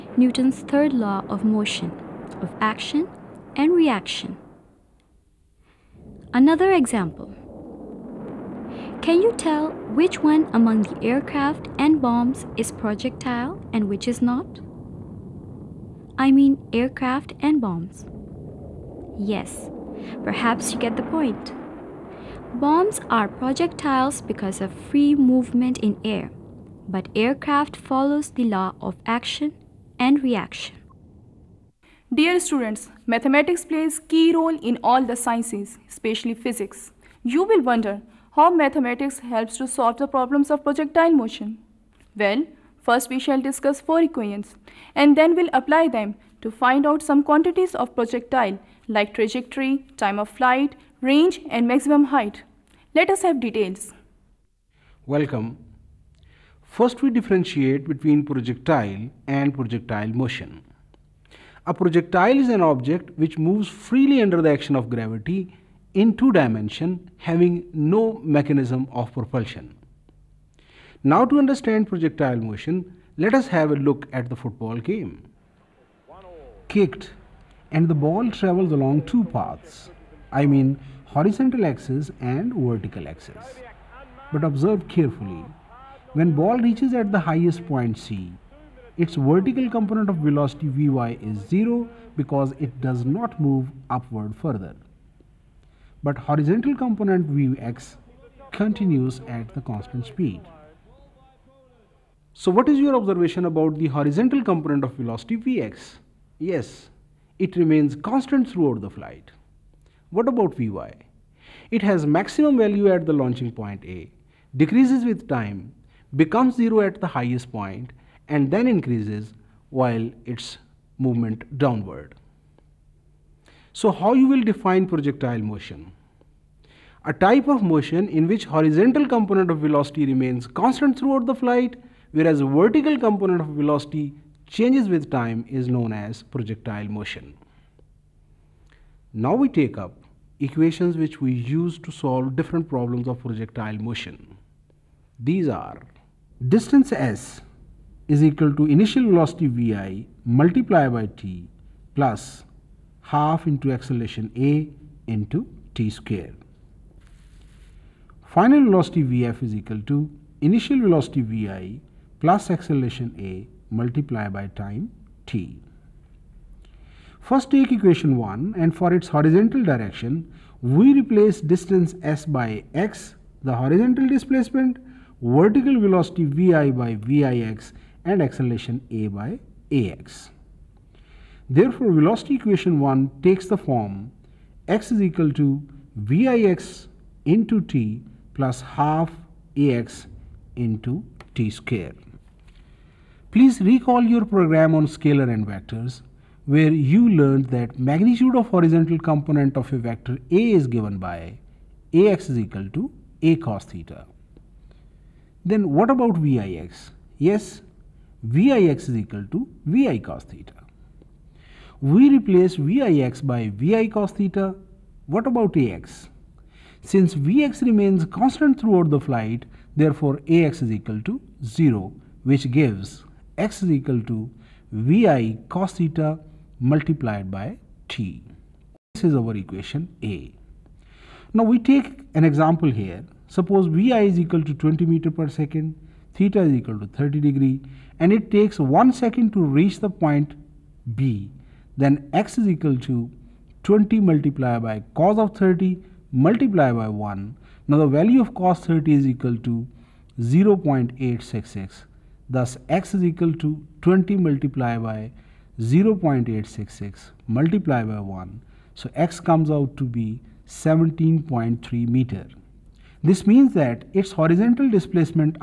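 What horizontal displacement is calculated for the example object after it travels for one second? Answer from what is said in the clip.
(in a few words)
17.3 meters.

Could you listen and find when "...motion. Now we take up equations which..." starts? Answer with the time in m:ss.
2:16.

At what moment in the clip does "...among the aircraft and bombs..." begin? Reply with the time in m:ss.
0:10.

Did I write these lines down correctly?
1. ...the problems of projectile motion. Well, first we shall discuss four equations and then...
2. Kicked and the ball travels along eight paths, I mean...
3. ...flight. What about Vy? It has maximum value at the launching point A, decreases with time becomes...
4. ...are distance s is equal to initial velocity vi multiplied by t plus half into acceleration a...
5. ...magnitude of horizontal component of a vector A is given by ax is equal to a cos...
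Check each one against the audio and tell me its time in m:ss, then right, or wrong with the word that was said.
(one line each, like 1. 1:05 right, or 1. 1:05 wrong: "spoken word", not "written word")
1. 0:39 right
2. 1:16 wrong: "two", not "eight"
3. 1:48 right
4. 2:25 right
5. 3:17 right.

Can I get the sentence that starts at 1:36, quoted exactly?
But horizontal component Vx continues at the constant speed.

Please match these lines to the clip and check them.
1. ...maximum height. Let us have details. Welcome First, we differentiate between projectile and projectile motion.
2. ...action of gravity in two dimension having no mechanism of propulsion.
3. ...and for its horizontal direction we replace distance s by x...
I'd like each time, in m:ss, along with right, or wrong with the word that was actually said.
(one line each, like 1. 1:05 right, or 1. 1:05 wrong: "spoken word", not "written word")
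1. 0:51 right
2. 1:04 right
3. 2:48 right.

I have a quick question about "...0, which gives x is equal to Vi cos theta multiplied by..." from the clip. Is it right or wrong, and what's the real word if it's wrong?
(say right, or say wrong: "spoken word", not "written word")
right.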